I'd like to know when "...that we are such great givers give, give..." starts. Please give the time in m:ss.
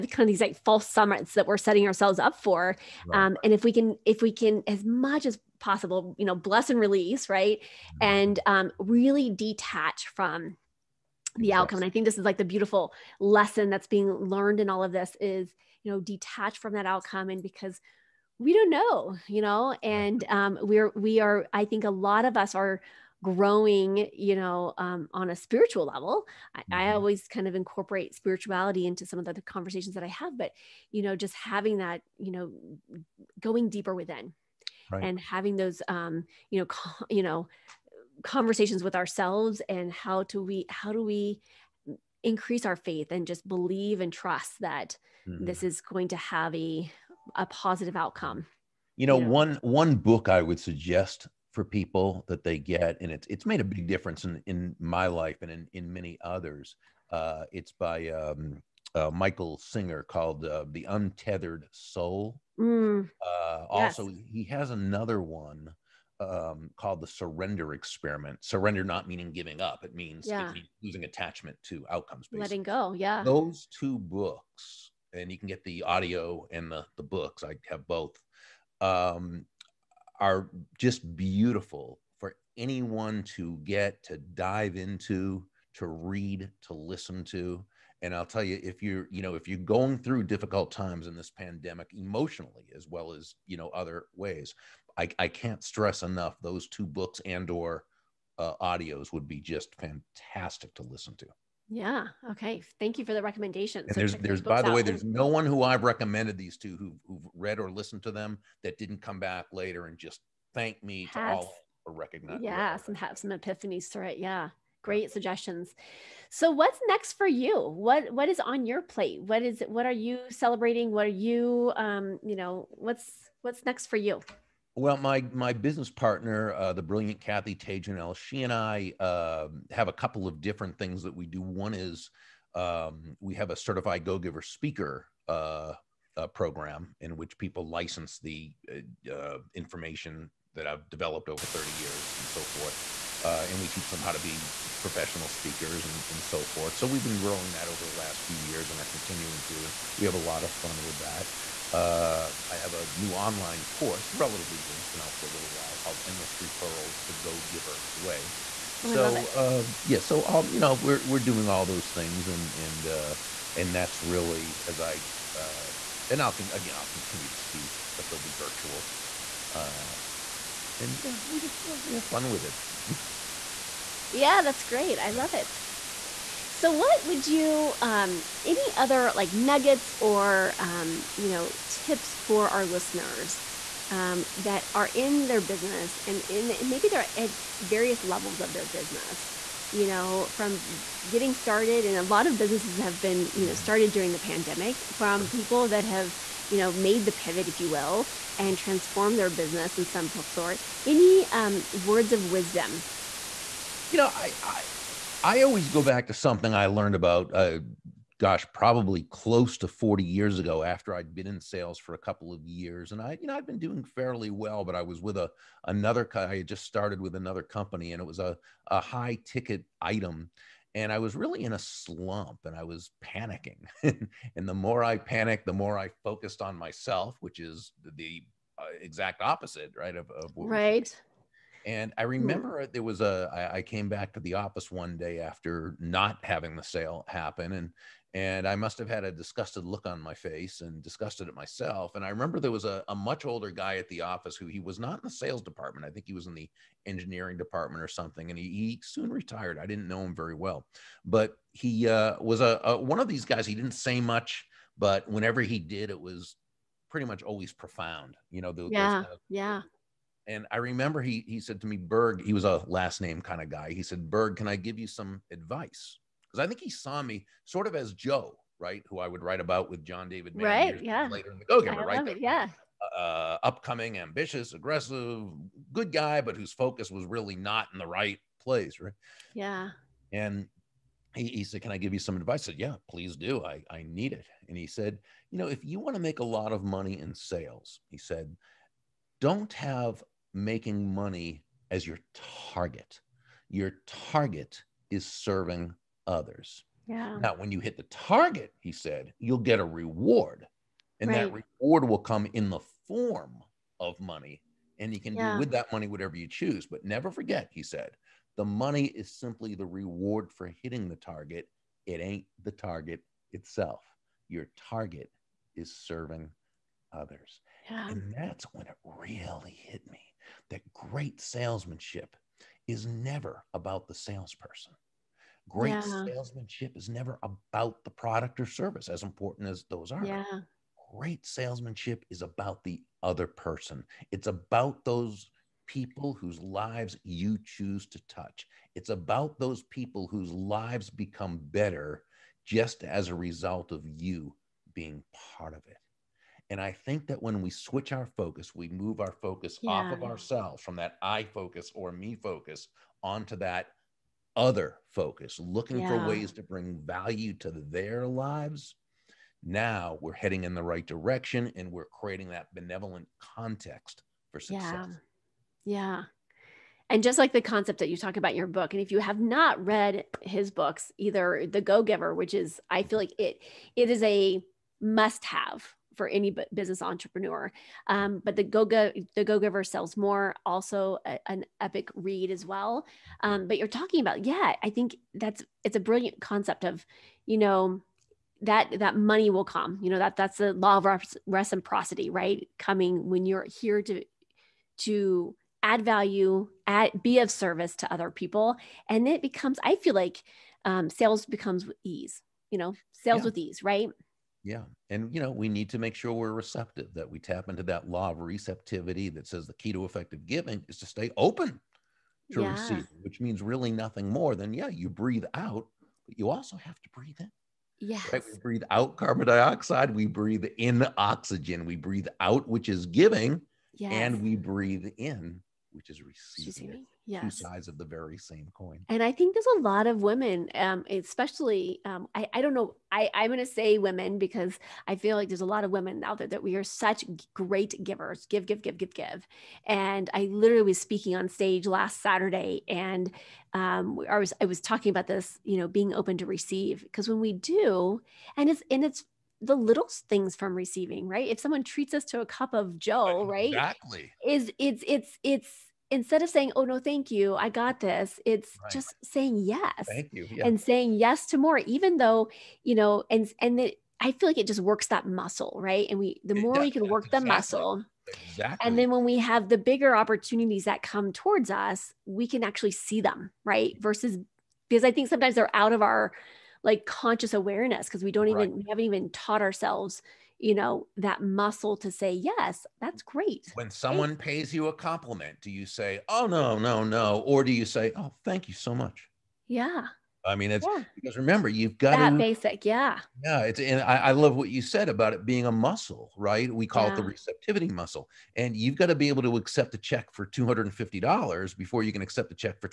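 7:16.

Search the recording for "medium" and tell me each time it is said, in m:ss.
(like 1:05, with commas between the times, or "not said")
not said.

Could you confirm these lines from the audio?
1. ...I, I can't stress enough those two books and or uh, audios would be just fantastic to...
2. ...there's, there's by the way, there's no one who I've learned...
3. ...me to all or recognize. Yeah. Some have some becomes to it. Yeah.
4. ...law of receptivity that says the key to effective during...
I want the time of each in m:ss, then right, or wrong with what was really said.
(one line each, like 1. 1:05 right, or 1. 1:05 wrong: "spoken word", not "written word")
1. 1:34 right
2. 1:43 wrong: "recommended", not "learned"
3. 1:50 wrong: "epiphanies", not "becomes"
4. 6:47 wrong: "giving", not "during".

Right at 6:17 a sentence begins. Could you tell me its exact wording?
Um, but the Go-Go, the Go-Giver sells more, also a, an epic read as well.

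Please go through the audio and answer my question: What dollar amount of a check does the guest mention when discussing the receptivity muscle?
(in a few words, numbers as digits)
$250.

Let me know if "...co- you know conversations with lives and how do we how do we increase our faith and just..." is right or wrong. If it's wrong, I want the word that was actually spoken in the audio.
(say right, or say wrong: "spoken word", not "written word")
wrong: "ourselves", not "lives".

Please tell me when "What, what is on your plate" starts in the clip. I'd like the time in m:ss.
1:57.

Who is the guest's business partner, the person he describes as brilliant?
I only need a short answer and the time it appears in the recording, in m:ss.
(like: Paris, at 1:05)
Kathy Tagenel, at 2:07.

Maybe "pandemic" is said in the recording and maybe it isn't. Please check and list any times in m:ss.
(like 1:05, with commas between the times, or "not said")
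1:31, 3:14.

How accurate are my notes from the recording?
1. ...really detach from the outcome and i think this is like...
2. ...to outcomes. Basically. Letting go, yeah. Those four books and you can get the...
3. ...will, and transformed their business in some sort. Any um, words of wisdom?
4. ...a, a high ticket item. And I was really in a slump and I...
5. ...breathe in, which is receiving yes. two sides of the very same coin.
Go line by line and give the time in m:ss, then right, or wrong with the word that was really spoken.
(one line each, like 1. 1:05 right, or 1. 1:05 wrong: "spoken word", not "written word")
1. 0:08 right
2. 1:11 wrong: "two", not "four"
3. 3:17 right
4. 3:38 right
5. 7:04 right.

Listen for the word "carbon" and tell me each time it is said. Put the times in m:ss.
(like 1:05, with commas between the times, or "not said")
6:58.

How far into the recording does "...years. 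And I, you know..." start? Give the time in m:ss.
3:32.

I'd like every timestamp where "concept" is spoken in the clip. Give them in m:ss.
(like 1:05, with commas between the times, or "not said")
6:07, 6:26.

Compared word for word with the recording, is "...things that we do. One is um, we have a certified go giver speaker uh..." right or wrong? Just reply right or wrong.
right.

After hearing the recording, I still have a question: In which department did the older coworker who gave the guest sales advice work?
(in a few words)
engineering.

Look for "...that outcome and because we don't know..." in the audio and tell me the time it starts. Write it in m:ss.
0:16.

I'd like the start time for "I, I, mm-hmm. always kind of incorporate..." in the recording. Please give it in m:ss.
0:26.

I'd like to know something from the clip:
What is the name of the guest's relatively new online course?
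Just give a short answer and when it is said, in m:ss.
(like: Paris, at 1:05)
Endless Referrals: The Go Giver Way, at 2:36.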